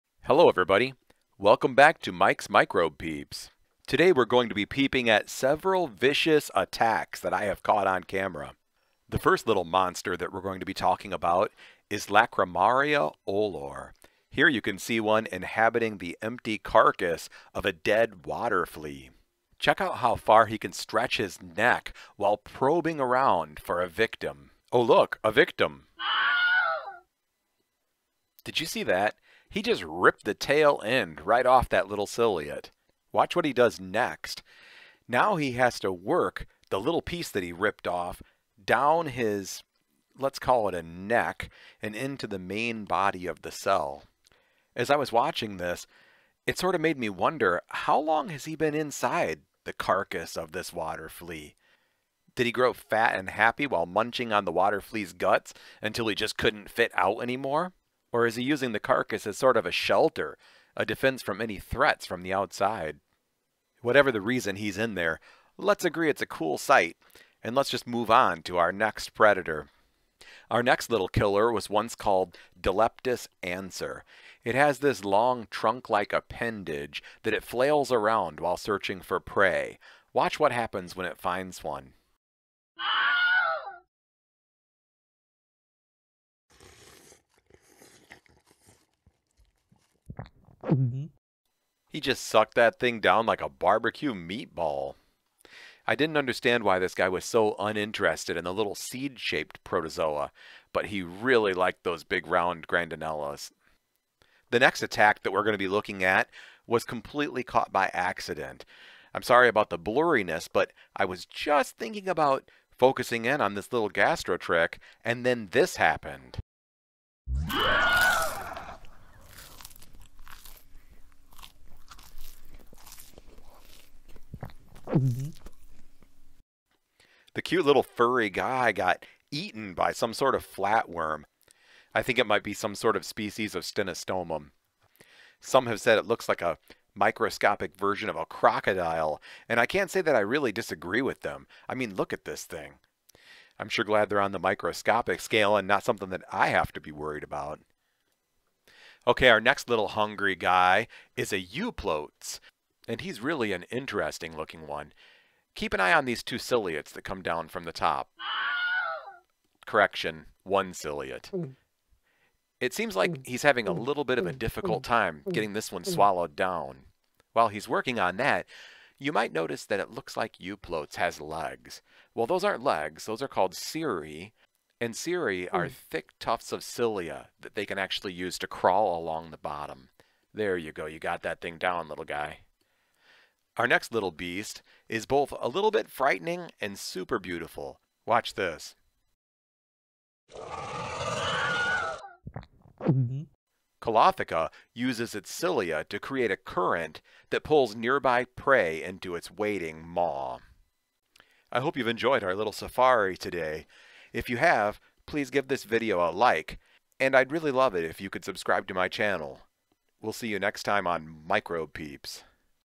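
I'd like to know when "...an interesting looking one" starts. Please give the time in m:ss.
2:33.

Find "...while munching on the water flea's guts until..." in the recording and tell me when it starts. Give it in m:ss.
0:53.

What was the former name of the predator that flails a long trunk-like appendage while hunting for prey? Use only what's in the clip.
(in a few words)
Dileptus anser.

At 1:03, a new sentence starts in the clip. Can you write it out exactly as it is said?
Whatever the reason he's in there, let's agree it's a cool sight, and let's just move on to our next predator.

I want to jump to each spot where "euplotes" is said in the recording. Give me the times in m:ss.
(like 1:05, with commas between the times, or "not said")
2:31, 2:50.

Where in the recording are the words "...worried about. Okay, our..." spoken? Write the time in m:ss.
2:26.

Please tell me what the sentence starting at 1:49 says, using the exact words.
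I'm sorry about the blurriness, but I was just thinking about focusing in on this little gastrotrich, and then this happened.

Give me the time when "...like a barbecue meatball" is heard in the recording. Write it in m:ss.
1:33.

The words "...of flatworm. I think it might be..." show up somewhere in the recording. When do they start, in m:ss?
2:10.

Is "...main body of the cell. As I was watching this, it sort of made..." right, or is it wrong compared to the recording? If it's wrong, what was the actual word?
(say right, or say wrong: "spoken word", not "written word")
right.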